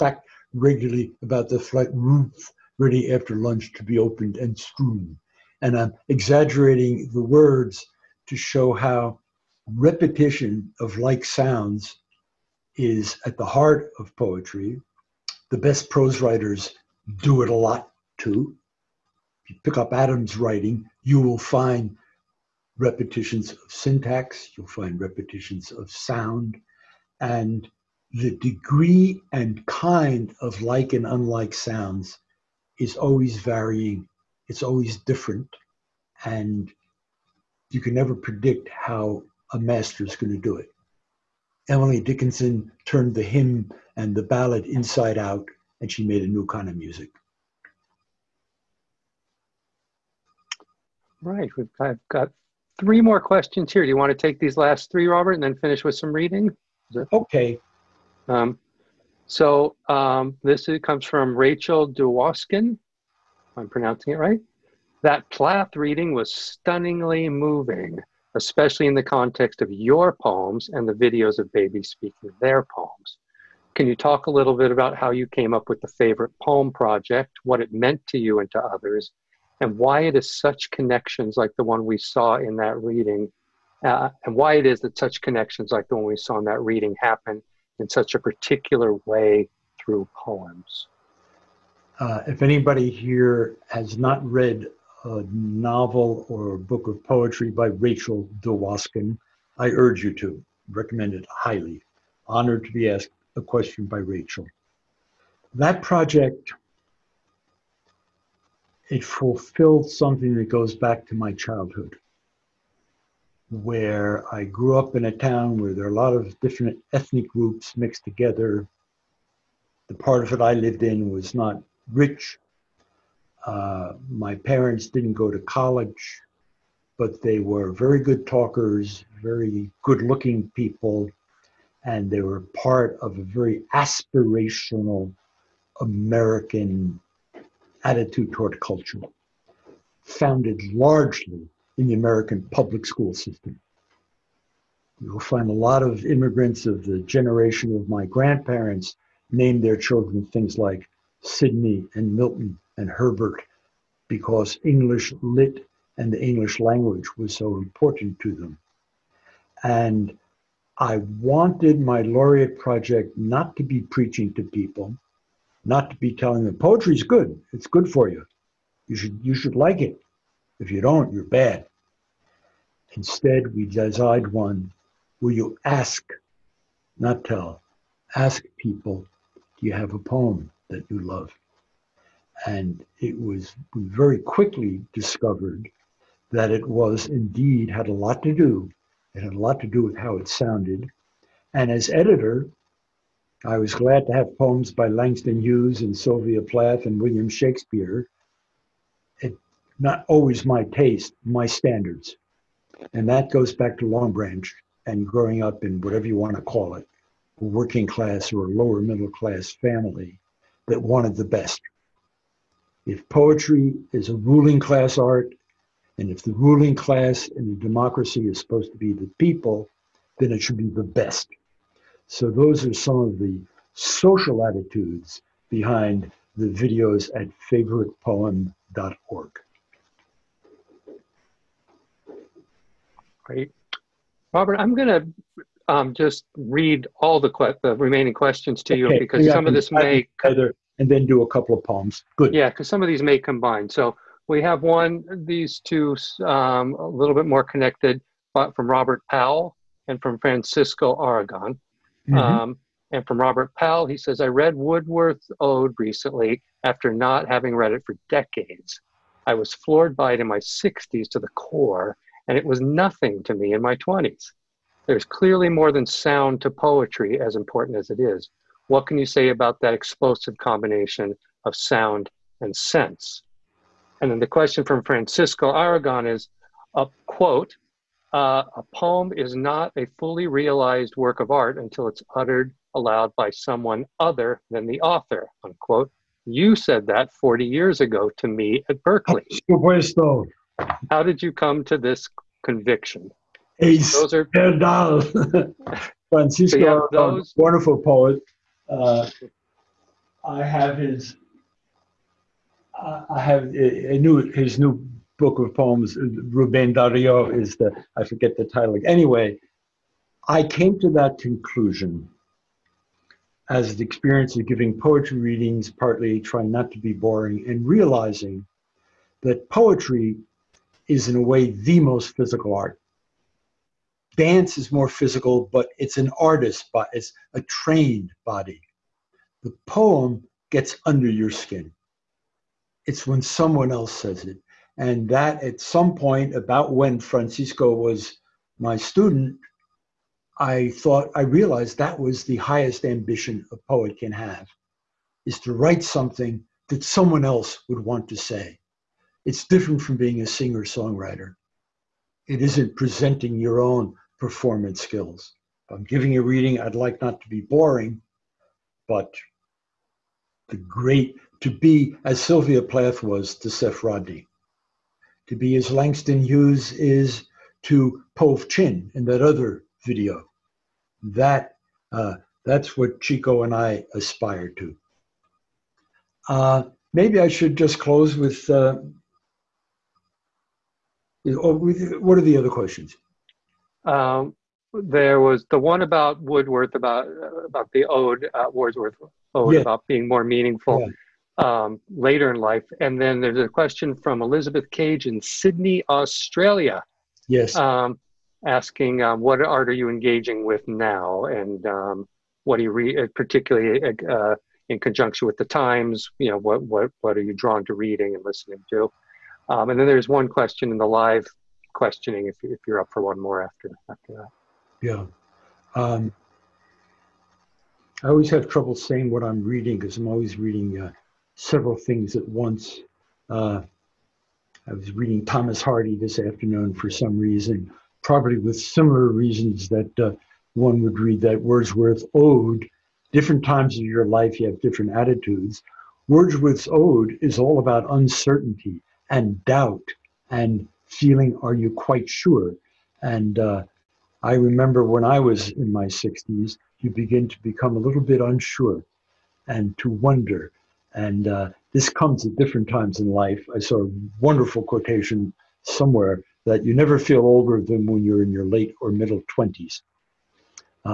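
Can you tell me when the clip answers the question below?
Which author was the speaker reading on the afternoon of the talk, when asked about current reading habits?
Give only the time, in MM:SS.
07:05.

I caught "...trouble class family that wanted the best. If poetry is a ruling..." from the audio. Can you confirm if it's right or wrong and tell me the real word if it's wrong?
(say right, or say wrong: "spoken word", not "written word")
wrong: "middle", not "trouble".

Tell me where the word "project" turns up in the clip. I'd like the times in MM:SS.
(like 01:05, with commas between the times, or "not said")
01:16, 01:45, 02:42.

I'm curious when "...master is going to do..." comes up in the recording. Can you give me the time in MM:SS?
00:39.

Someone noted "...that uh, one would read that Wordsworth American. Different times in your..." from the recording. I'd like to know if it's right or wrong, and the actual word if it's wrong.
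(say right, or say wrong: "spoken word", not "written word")
wrong: "Ode", not "American".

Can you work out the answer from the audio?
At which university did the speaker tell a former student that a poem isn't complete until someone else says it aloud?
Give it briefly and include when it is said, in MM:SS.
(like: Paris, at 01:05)
Berkeley, at 04:48.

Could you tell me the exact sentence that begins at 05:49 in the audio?
It's different from being a singer songwriter.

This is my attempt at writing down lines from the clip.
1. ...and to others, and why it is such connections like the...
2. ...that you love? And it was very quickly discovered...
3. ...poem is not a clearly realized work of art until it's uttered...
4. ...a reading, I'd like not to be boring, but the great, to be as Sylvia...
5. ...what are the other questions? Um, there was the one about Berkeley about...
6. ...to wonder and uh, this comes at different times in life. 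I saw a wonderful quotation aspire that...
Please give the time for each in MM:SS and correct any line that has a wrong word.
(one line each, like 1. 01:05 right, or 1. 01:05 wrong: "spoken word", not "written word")
1. 01:18 right
2. 03:00 right
3. 04:38 wrong: "fully", not "clearly"
4. 05:56 right
5. 06:21 wrong: "Wordsworth", not "Berkeley"
6. 07:29 wrong: "somewhere", not "aspire".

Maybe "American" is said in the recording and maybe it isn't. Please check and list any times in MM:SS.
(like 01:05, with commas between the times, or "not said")
02:15, 02:21.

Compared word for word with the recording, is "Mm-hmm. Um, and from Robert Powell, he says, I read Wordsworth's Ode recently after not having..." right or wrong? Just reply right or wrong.
right.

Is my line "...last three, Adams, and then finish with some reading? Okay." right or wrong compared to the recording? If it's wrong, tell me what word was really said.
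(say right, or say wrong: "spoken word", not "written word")
wrong: "Robert", not "Adams".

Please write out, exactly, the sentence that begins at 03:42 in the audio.
So those are some of the social attitudes behind the videos at favoritepoem.org.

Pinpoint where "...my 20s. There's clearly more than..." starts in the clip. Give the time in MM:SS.
04:23.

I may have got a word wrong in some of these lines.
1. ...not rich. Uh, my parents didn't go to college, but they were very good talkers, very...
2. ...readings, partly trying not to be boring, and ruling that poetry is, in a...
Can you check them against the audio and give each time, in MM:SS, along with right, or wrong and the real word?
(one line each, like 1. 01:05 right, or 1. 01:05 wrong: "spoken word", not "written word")
1. 02:01 right
2. 05:15 wrong: "realizing", not "ruling".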